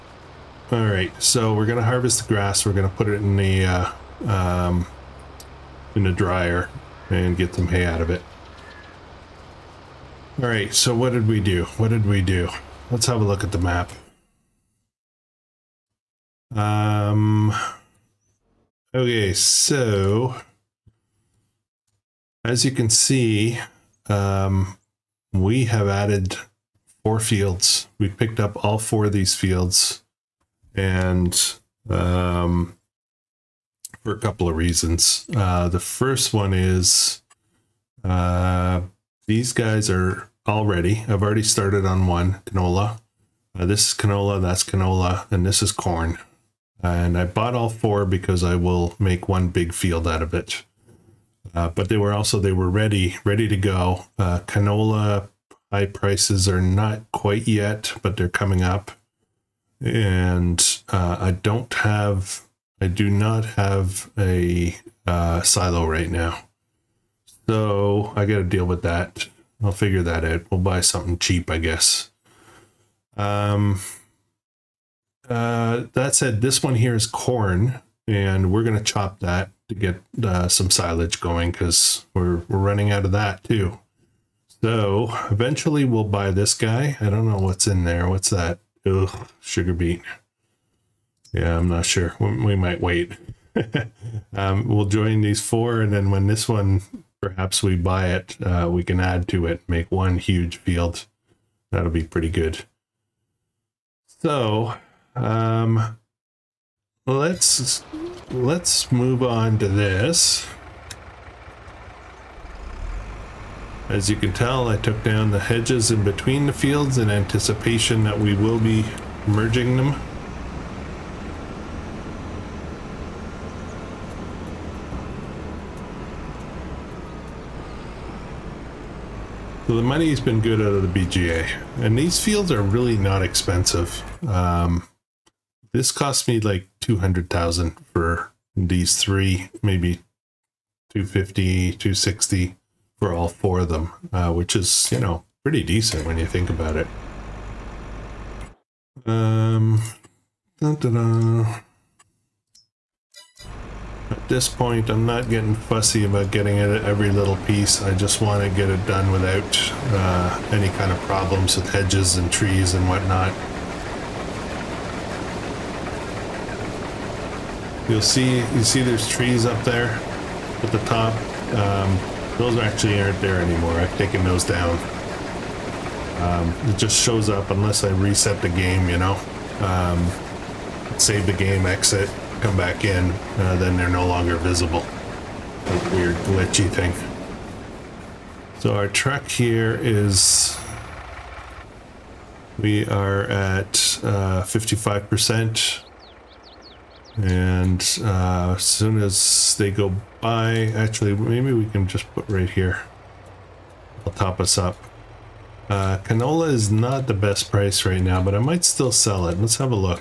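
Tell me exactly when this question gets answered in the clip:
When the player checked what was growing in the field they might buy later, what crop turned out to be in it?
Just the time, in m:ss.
1:29.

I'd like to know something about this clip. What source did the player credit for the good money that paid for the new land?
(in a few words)
The BGA.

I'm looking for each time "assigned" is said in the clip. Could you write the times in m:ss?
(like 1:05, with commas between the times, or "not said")
not said.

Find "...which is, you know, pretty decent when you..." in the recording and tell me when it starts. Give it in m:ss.
2:24.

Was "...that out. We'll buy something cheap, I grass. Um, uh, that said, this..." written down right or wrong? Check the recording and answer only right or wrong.
wrong.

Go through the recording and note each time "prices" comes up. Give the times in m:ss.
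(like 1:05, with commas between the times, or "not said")
0:55, 3:27.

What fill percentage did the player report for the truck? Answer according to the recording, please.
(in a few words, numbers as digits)
55%.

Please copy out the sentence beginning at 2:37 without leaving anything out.
I just want to get it done without uh, any kind of problems with hedges and trees and whatnot.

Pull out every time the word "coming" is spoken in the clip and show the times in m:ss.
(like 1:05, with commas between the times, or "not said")
0:58.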